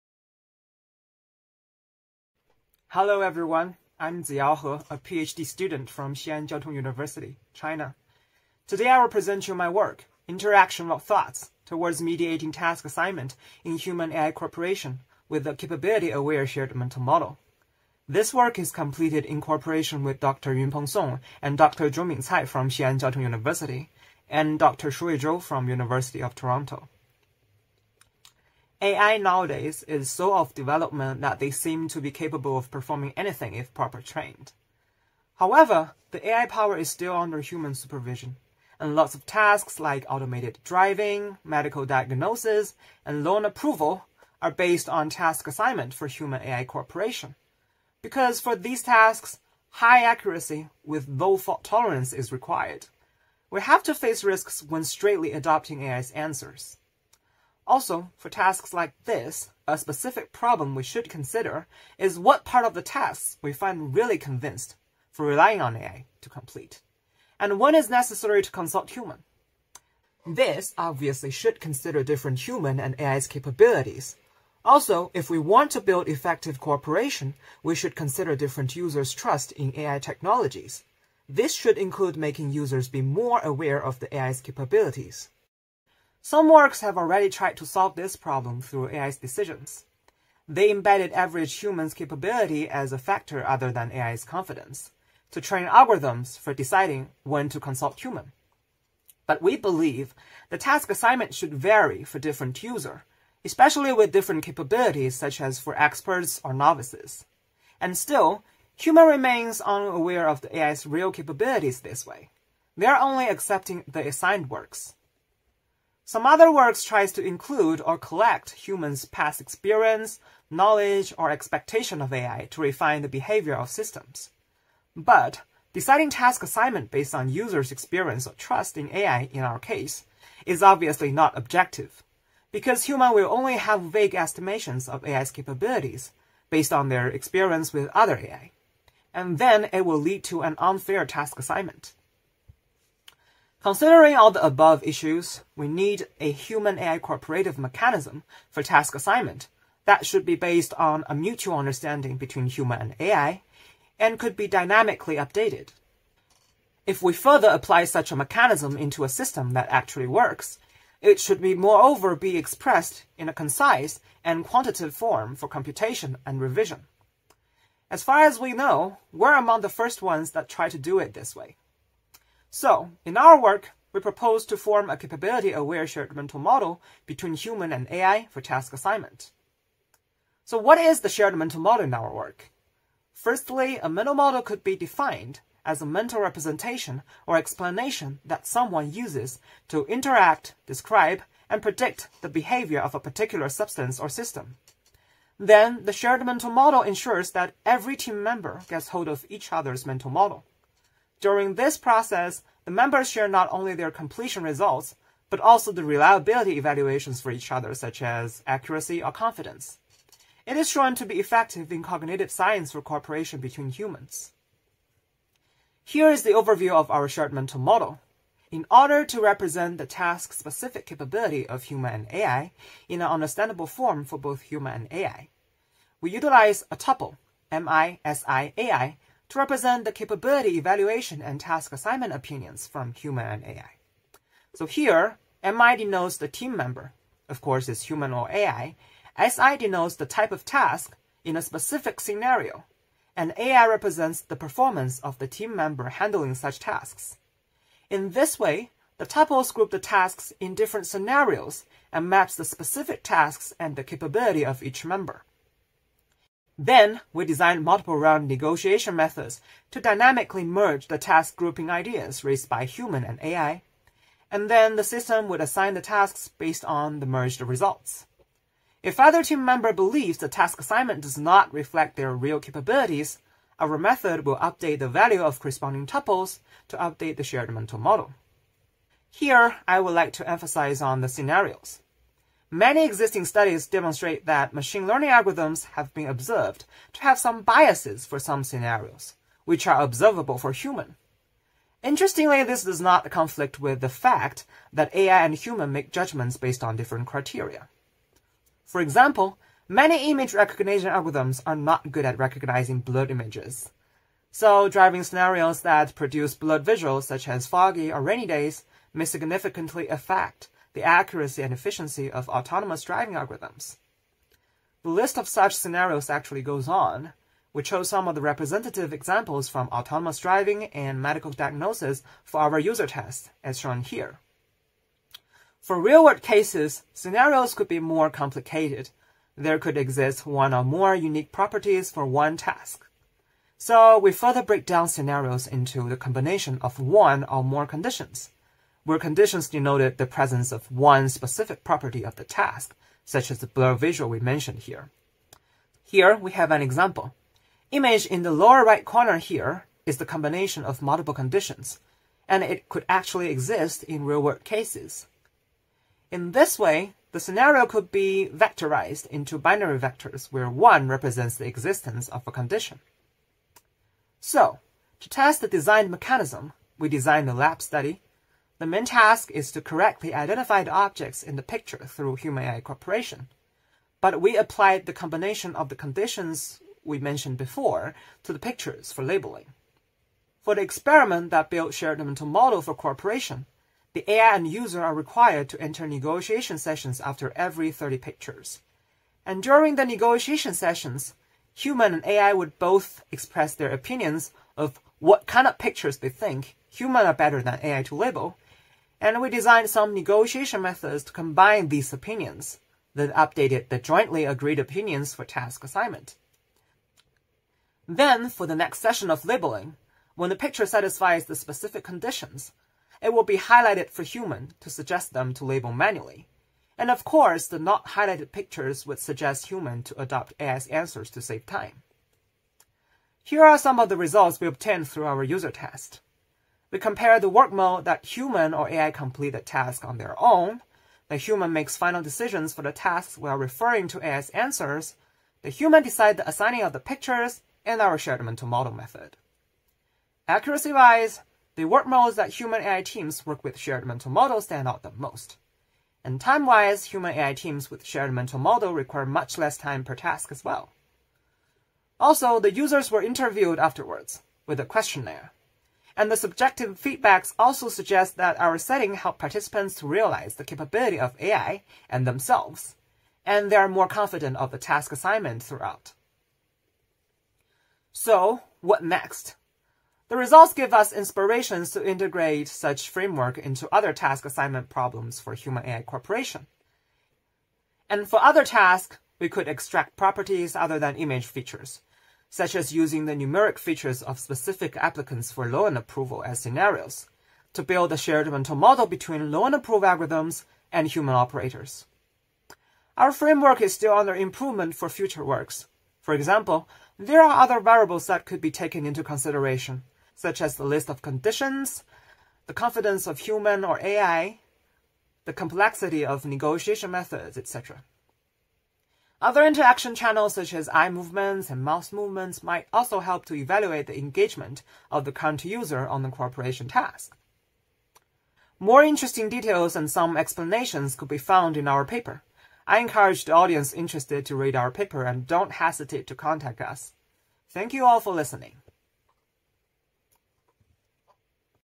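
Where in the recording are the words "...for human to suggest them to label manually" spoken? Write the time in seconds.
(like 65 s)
413 s.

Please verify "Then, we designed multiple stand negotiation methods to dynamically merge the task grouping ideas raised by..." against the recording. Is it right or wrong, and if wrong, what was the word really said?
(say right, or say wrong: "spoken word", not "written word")
wrong: "round", not "stand".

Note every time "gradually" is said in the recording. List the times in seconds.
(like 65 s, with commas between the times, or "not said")
not said.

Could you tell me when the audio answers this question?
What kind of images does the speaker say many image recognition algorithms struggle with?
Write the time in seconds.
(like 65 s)
302 s.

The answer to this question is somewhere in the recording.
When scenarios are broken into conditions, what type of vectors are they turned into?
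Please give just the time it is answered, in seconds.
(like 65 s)
359 s.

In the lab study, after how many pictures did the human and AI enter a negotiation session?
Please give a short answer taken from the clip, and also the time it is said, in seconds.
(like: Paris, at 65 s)
30, at 387 s.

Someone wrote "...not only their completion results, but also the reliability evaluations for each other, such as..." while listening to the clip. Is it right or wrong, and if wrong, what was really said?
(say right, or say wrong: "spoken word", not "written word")
right.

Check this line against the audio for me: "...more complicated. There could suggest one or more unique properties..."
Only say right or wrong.
wrong.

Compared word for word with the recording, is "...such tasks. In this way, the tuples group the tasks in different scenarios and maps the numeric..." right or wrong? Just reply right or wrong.
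wrong.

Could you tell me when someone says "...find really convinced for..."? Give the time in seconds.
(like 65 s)
63 s.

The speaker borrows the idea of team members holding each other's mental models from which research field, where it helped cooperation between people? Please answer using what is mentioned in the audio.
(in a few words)
cognitive science.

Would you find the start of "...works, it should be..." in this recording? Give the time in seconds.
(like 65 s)
160 s.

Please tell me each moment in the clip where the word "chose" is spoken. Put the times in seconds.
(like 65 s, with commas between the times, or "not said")
317 s.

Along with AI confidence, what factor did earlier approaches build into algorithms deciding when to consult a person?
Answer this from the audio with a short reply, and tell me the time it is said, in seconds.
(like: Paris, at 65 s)
average humans' capability, at 91 s.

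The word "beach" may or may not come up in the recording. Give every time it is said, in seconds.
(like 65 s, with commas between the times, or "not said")
not said.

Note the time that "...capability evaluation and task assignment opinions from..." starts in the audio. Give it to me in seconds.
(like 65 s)
229 s.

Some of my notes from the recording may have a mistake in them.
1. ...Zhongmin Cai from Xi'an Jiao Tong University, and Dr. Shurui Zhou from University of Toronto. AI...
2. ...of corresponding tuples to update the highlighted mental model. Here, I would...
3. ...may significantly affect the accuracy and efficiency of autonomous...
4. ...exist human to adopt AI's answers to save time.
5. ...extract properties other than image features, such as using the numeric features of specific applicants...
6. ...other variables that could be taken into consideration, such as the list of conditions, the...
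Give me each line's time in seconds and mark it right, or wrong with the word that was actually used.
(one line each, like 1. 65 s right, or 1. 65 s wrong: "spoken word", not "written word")
1. 21 s right
2. 275 s wrong: "shared", not "highlighted"
3. 308 s right
4. 418 s wrong: "suggest", not "exist"
5. 479 s right
6. 497 s right.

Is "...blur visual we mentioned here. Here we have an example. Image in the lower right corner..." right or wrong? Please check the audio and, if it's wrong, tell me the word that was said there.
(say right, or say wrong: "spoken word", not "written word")
right.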